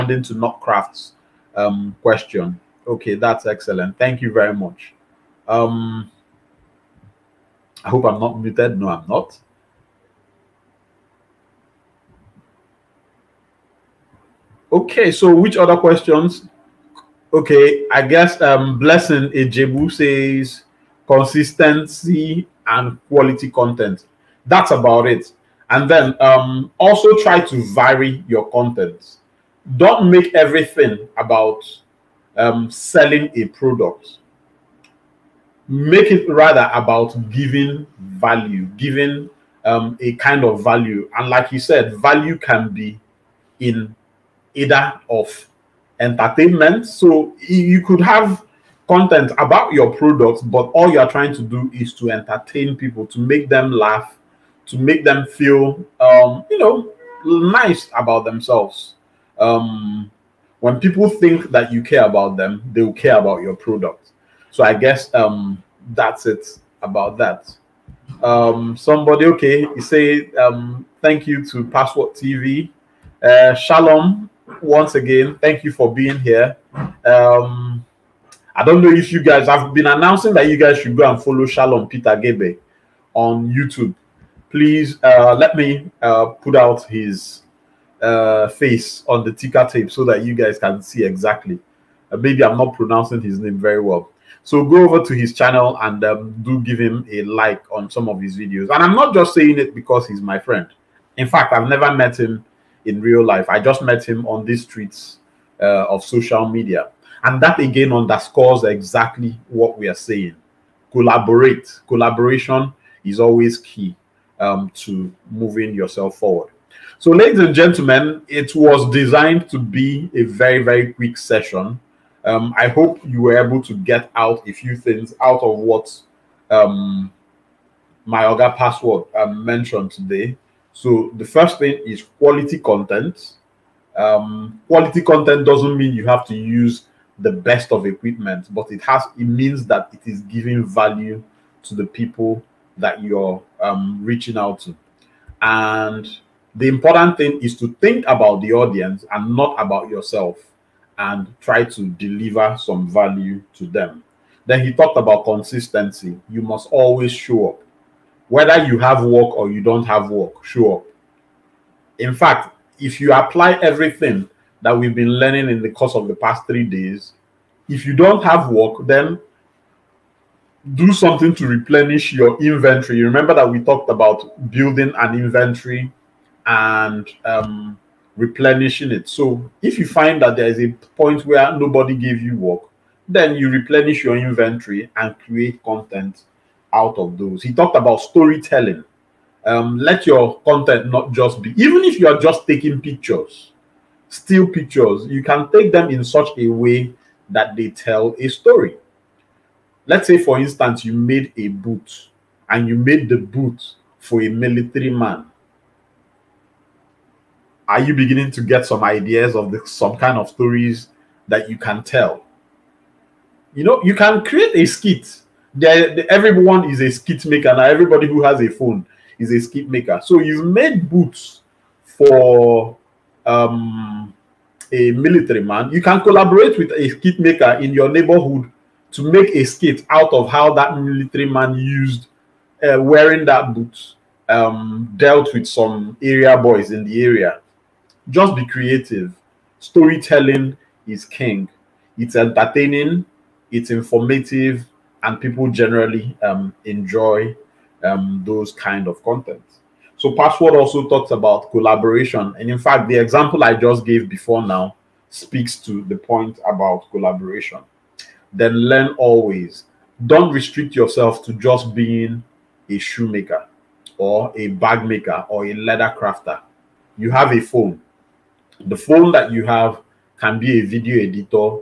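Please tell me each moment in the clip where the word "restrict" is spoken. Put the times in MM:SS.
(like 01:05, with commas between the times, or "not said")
04:20.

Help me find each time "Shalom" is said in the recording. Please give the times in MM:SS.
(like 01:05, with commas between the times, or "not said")
01:13, 01:21.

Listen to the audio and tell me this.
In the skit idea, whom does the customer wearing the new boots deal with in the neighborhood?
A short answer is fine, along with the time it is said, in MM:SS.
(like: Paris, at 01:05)
area boys, at 03:56.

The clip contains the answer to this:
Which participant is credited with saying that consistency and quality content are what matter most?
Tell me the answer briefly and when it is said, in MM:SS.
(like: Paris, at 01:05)
Blessing Ejebu, at 00:18.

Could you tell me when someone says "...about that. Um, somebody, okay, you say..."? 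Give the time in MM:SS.
01:06.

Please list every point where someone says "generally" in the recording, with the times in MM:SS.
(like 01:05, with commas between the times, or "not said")
04:05.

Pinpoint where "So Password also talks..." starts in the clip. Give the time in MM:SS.
04:09.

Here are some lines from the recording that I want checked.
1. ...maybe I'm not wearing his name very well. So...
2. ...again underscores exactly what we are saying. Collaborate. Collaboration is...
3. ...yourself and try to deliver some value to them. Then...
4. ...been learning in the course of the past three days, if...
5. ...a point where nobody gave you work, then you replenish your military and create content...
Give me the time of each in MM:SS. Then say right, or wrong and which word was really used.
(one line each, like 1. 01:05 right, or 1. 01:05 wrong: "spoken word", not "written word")
1. 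01:32 wrong: "pronouncing", not "wearing"
2. 01:47 right
3. 02:29 right
4. 02:44 right
5. 03:00 wrong: "inventory", not "military".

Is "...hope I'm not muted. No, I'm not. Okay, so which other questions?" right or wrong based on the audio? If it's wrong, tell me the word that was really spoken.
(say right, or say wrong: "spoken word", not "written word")
right.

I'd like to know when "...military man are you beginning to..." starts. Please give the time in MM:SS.
03:24.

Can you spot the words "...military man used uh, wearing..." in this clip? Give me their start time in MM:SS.
03:50.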